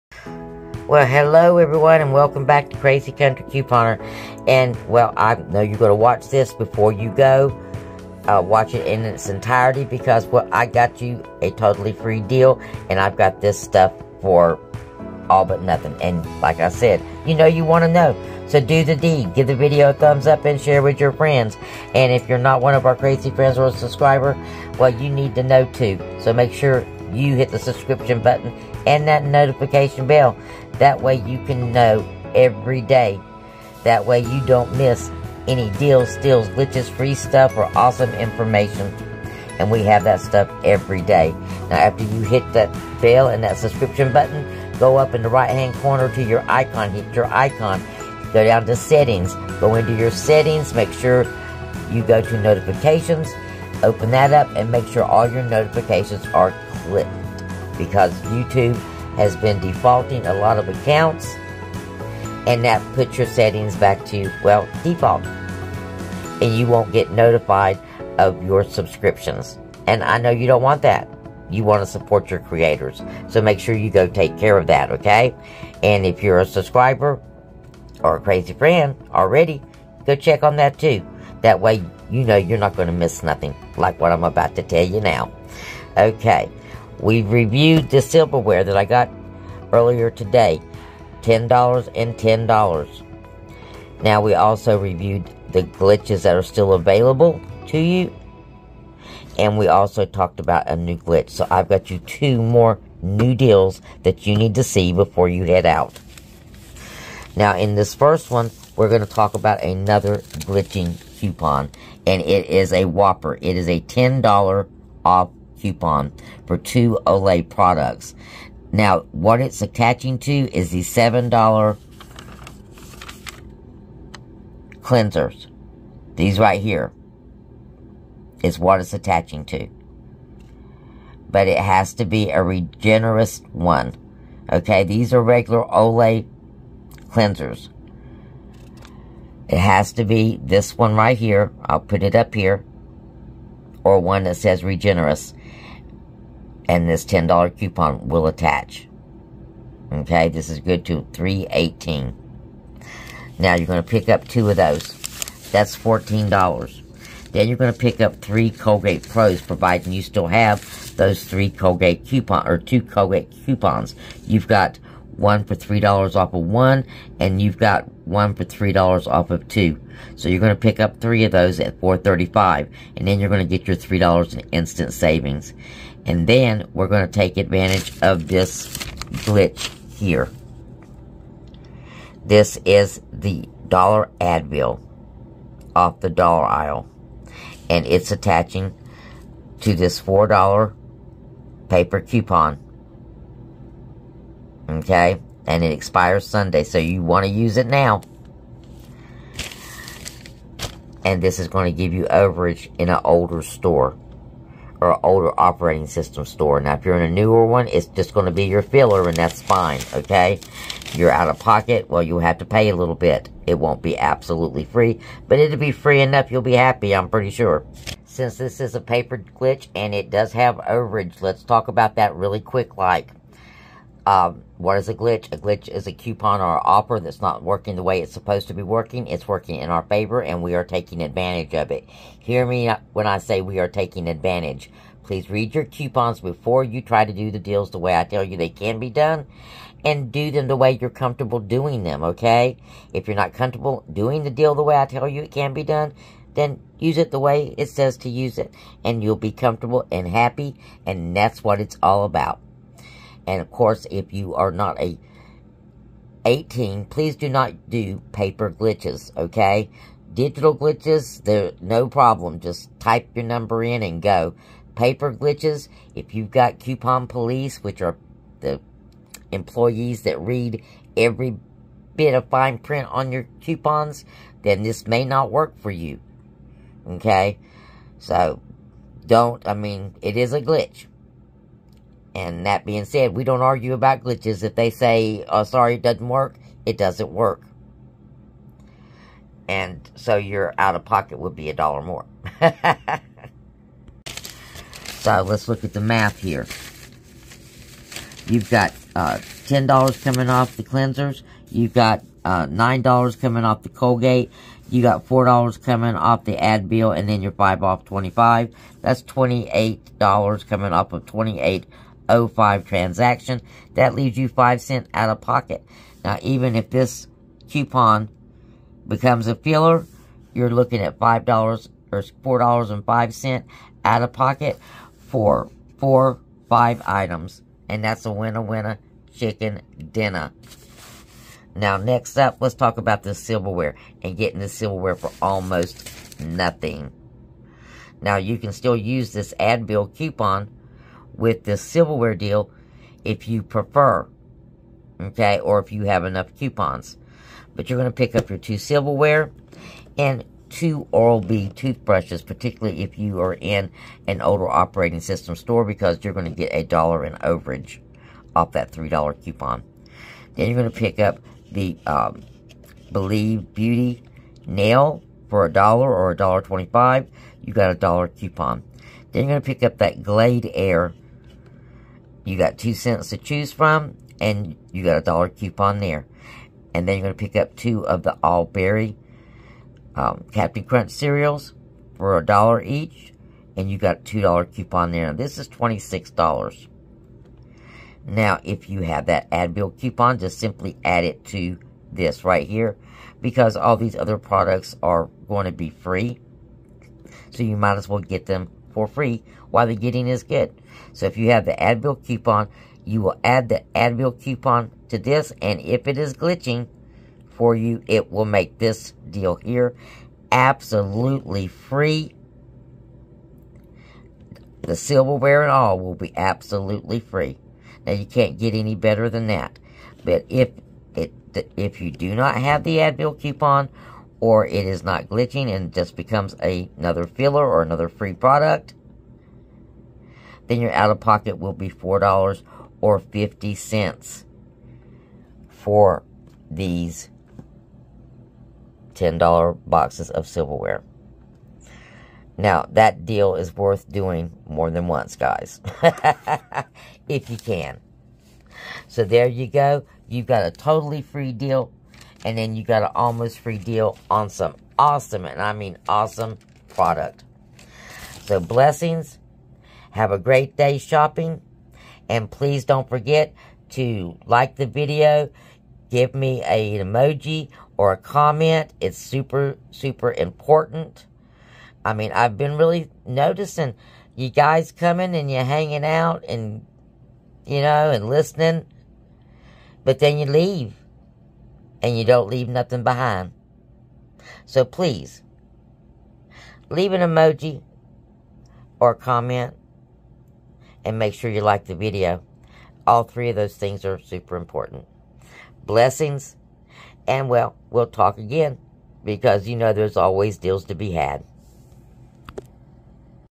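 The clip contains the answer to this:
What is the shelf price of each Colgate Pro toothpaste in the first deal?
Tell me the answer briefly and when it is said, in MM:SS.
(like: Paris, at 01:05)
$4.35, at 02:51.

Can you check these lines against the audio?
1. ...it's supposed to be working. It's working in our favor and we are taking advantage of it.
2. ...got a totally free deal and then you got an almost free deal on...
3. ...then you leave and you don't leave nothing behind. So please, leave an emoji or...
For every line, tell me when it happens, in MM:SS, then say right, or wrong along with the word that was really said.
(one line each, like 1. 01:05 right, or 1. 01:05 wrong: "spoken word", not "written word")
1. 03:47 right
2. 07:30 right
3. 07:59 right.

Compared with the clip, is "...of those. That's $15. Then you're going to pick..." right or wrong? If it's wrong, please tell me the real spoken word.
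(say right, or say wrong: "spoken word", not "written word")
wrong: "14", not "15".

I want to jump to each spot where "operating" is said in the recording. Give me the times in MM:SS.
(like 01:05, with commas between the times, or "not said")
03:25, 05:54.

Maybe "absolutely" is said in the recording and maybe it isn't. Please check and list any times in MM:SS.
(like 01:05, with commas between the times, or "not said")
03:33, 06:50, 06:56.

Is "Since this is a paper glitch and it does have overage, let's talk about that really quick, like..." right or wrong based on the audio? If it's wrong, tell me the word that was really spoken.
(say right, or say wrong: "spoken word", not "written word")
right.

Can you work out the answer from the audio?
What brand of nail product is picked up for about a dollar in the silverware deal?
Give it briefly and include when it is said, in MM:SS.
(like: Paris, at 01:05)
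Believe Beauty, at 06:02.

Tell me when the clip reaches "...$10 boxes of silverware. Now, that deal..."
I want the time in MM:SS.
07:18.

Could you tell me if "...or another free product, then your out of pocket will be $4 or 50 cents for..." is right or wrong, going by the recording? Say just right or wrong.
right.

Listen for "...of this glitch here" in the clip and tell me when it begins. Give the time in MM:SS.
02:58.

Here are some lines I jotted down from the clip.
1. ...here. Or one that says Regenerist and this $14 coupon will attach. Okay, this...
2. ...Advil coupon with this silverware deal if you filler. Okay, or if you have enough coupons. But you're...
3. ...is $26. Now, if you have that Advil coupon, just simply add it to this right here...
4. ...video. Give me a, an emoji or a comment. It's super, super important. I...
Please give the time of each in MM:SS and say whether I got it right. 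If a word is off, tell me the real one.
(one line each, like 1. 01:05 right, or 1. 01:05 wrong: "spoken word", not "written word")
1. 02:22 wrong: "10", not "14"
2. 05:39 wrong: "prefer", not "filler"
3. 06:25 right
4. 07:44 right.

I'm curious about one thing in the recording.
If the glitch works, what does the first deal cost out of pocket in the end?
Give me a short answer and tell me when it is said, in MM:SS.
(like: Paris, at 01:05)
5 cents, at 05:14.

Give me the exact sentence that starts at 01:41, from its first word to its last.
So I've got you two more new deals that you need to see before you head out.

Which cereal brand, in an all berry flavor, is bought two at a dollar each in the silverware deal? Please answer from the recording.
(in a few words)
Captain Crunch.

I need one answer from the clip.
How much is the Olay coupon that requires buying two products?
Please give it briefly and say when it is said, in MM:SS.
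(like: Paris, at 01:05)
$10 off, at 01:53.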